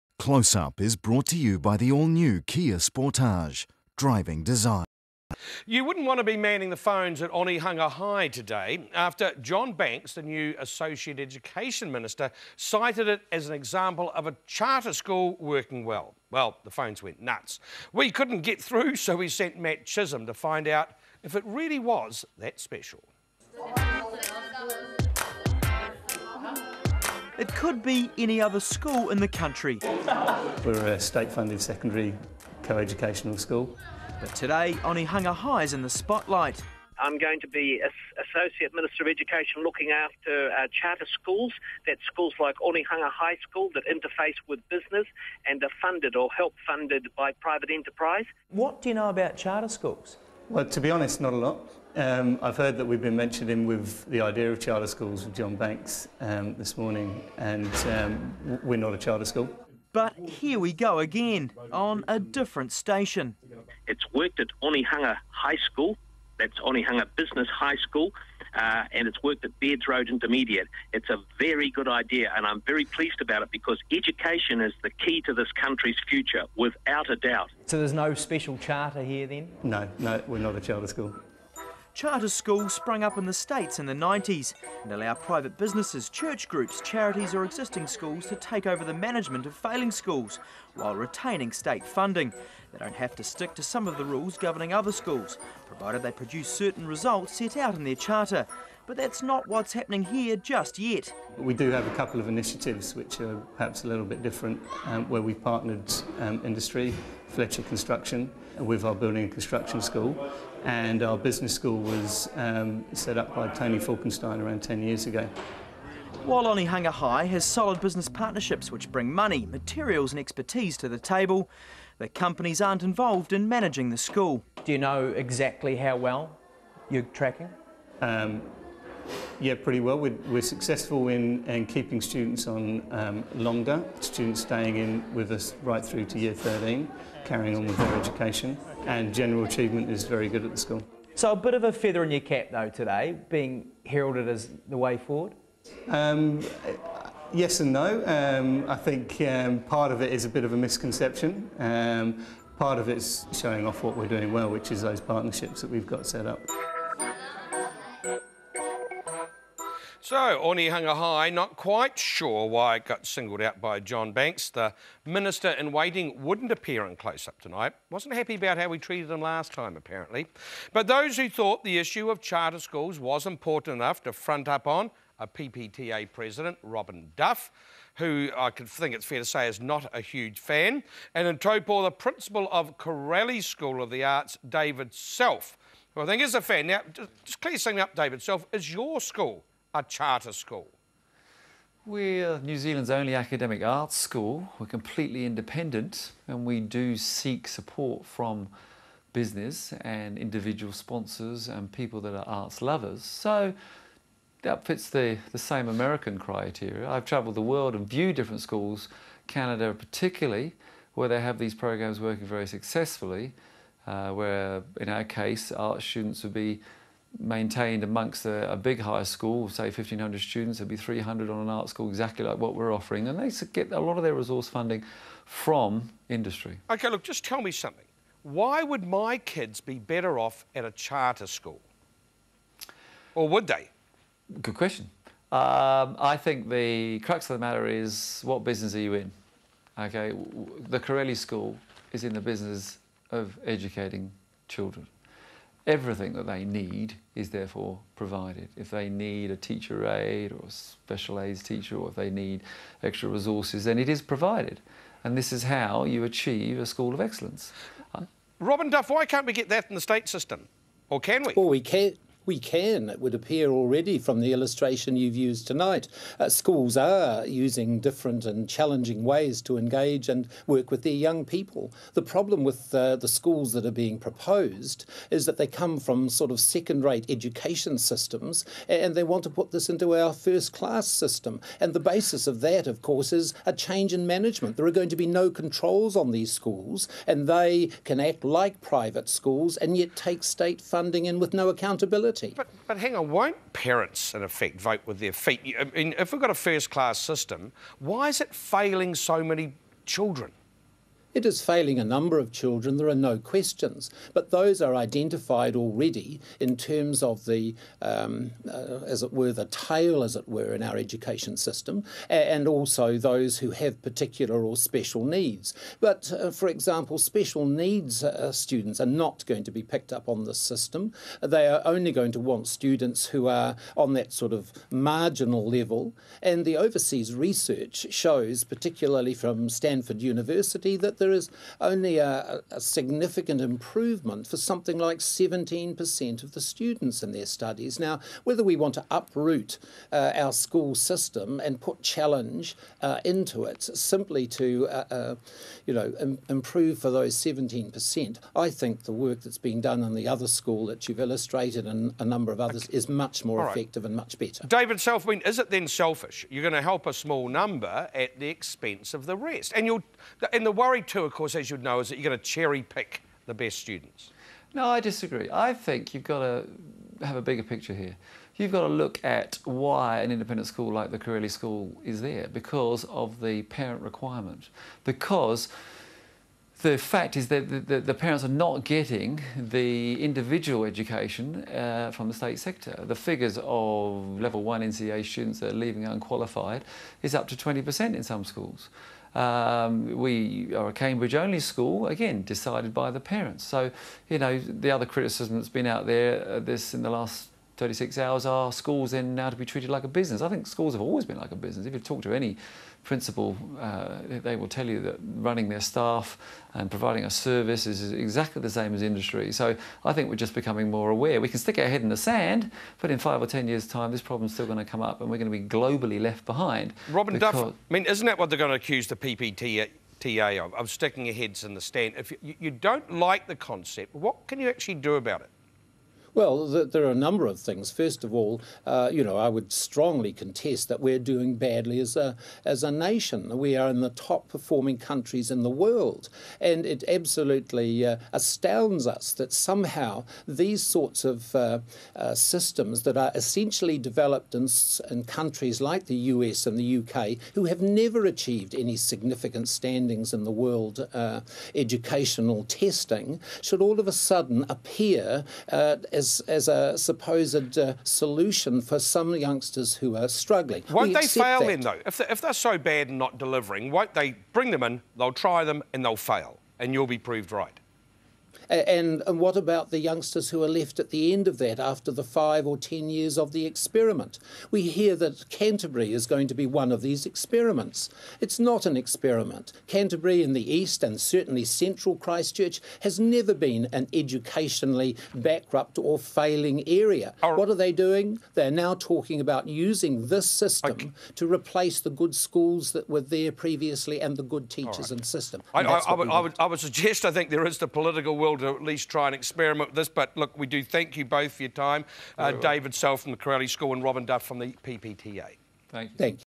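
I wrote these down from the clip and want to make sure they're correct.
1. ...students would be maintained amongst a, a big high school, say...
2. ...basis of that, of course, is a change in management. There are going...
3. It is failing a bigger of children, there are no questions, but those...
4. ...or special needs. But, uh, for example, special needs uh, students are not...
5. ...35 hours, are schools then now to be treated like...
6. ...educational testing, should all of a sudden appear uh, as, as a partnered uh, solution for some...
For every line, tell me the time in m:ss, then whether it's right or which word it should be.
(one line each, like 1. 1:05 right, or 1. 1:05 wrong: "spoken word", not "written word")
1. 3:35 right
2. 4:41 right
3. 5:01 wrong: "number", not "bigger"
4. 5:14 right
5. 6:37 wrong: "36", not "35"
6. 7:31 wrong: "supposed", not "partnered".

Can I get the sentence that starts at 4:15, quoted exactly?
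And this is how you achieve a school of excellence.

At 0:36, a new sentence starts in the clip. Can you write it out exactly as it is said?
I'm going to be Associate Minister of Education looking after uh, charter schools.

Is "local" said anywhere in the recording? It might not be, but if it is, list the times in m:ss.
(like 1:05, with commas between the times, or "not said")
not said.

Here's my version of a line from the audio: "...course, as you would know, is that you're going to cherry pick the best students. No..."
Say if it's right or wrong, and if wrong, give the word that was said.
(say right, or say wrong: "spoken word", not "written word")
right.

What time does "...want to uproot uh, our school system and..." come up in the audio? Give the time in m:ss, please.
5:38.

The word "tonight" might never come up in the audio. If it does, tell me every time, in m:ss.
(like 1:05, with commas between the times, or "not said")
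2:47, 4:25.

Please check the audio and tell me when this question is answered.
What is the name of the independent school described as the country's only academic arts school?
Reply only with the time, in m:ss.
3:02.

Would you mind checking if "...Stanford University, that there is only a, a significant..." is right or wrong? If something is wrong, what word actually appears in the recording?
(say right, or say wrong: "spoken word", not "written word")
right.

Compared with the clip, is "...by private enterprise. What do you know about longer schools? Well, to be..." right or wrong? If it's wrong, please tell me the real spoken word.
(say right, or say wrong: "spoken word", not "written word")
wrong: "charter", not "longer".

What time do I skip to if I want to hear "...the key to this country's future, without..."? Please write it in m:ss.
1:14.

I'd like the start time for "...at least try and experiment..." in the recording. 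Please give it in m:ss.
8:18.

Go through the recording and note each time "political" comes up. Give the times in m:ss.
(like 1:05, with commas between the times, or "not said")
8:17.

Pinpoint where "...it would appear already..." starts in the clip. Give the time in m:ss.
4:22.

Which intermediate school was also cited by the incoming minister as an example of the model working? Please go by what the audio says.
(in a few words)
Bairds Road Intermediate.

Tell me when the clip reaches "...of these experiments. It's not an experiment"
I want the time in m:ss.
7:56.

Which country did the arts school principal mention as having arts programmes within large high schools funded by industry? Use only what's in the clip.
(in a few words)
Canada.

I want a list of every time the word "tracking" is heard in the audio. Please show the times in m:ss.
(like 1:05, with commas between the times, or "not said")
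2:07.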